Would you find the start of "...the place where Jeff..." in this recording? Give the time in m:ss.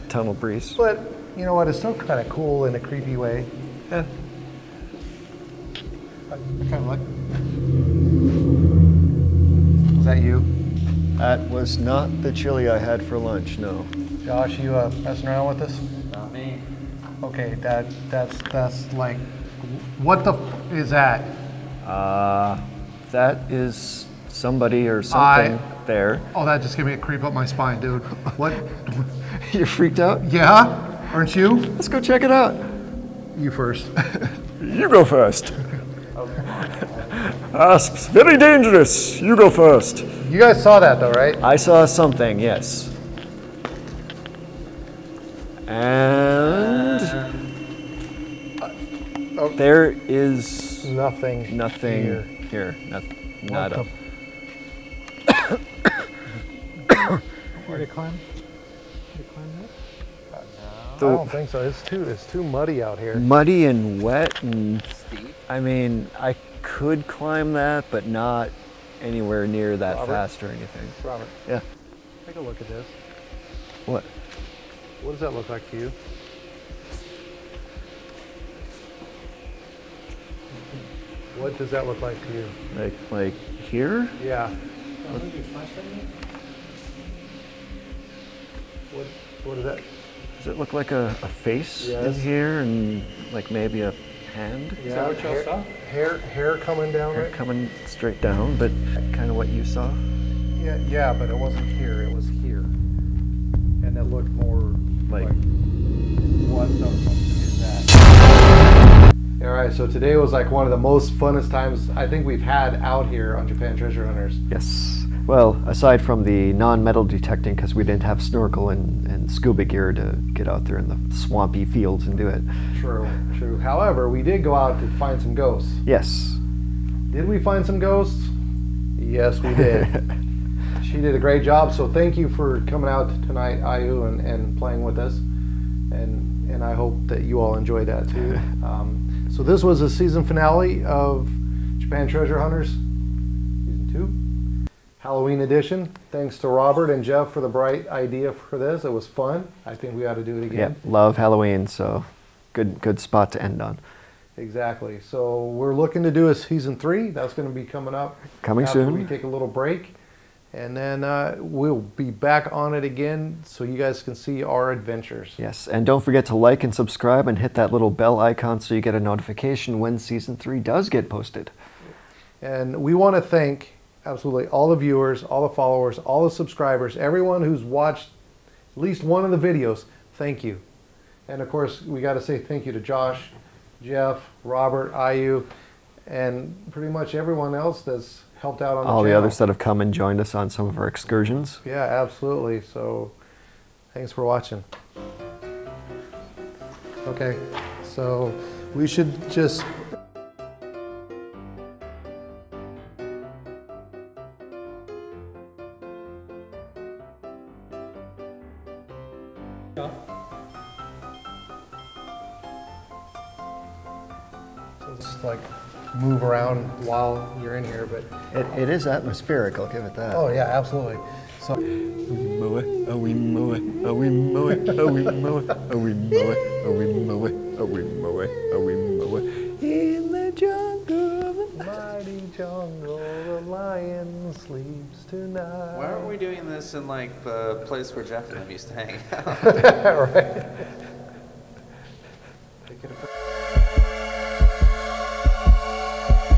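3:57.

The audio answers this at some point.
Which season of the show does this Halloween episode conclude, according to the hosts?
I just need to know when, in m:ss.
2:23.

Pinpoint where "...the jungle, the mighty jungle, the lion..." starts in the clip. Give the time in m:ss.
3:50.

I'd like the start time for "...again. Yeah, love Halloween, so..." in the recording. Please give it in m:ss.
2:30.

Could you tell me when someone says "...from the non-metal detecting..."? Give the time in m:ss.
1:56.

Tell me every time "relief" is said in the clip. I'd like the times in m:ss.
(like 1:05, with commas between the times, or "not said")
not said.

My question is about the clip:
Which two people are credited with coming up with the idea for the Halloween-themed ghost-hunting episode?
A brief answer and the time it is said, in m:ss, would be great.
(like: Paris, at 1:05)
Robert and Jeff, at 2:26.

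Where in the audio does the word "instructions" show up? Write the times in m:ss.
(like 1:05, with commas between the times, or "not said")
not said.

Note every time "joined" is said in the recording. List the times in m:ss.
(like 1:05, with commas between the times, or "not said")
3:09.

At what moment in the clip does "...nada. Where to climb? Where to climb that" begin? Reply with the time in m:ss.
0:53.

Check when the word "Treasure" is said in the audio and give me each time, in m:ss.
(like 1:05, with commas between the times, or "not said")
1:53, 2:22.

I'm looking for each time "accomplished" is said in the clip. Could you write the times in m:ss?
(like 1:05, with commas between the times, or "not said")
not said.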